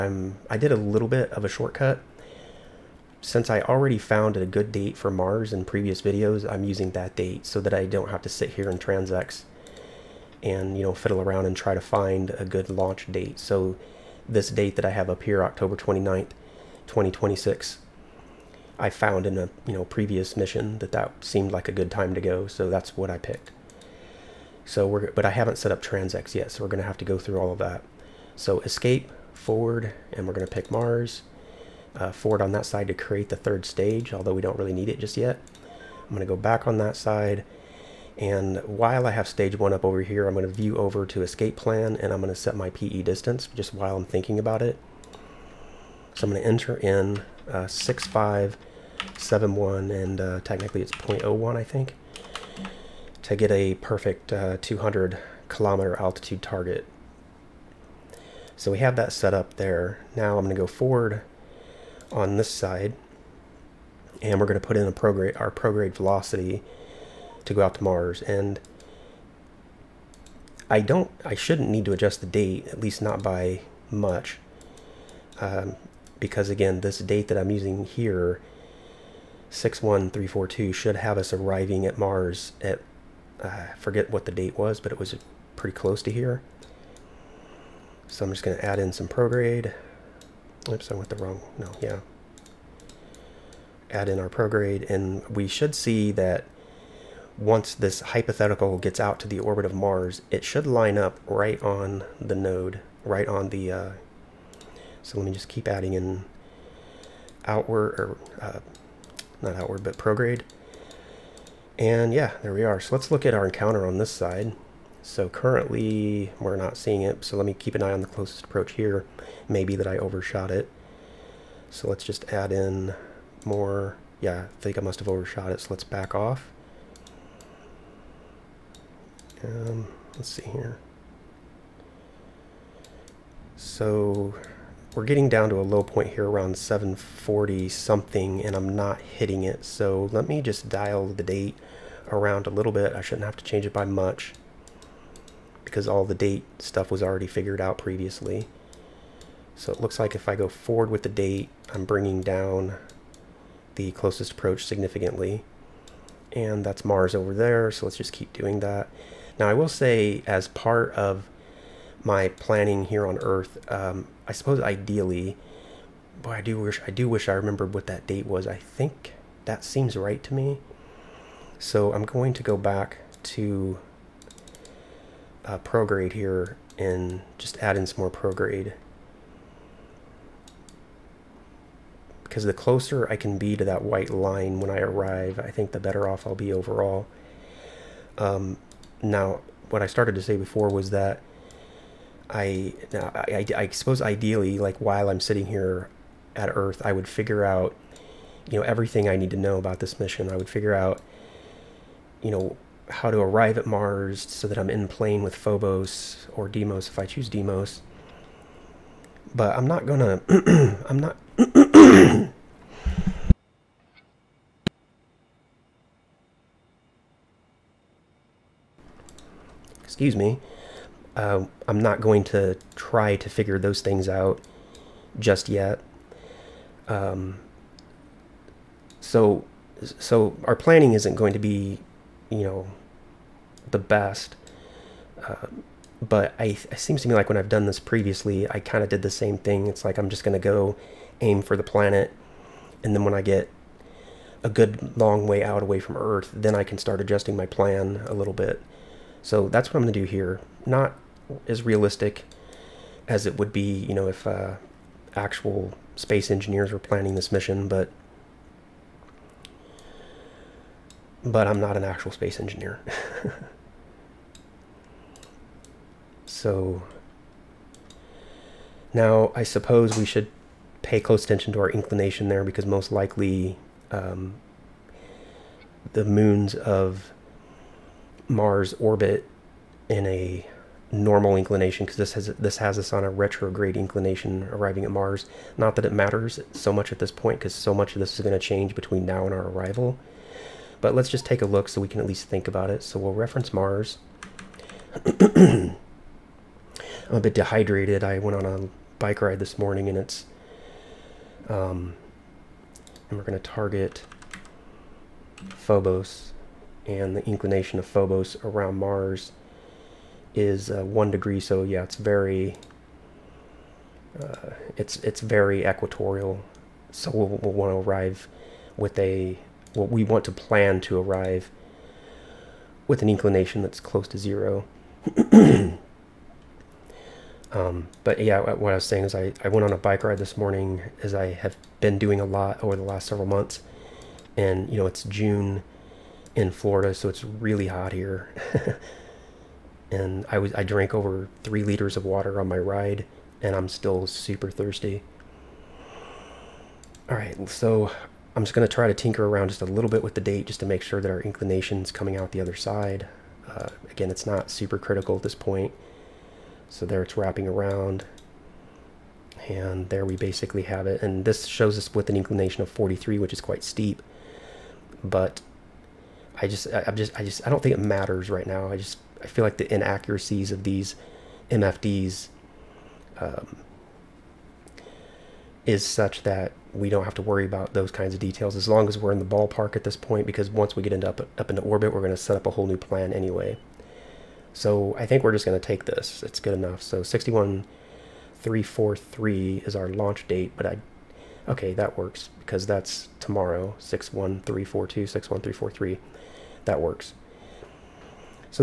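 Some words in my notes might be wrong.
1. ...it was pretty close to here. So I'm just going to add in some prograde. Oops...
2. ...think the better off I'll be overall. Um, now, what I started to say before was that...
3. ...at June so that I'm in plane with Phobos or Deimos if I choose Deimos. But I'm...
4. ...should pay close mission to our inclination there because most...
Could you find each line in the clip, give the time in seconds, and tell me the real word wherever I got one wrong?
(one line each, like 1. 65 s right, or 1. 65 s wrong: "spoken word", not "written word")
1. 84 s right
2. 185 s right
3. 203 s wrong: "Mars", not "June"
4. 270 s wrong: "attention", not "mission".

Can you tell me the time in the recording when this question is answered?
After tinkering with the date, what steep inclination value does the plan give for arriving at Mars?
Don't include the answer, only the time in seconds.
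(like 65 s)
362 s.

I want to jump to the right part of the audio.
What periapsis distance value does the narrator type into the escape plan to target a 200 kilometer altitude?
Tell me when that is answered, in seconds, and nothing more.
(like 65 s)
47 s.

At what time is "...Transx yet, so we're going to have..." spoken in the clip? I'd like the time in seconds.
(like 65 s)
25 s.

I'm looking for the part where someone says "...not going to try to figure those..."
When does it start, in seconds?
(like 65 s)
221 s.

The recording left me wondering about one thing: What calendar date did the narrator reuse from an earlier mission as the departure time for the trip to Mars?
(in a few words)
October 29th, 2026.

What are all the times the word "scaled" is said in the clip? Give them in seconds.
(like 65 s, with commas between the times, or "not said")
not said.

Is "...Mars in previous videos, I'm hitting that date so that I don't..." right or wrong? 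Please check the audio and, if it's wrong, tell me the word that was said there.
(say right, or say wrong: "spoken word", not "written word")
wrong: "using", not "hitting".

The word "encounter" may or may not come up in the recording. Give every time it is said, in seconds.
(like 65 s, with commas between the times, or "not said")
113 s.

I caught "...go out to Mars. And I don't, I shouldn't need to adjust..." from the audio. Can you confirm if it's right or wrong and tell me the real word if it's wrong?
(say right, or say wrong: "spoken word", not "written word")
right.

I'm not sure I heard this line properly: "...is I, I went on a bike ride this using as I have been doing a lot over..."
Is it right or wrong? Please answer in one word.
wrong.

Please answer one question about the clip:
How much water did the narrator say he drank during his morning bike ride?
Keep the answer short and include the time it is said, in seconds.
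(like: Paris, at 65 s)
Over 3 liters, at 340 s.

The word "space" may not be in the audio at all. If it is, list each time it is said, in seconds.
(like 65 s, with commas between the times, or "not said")
255 s, 262 s.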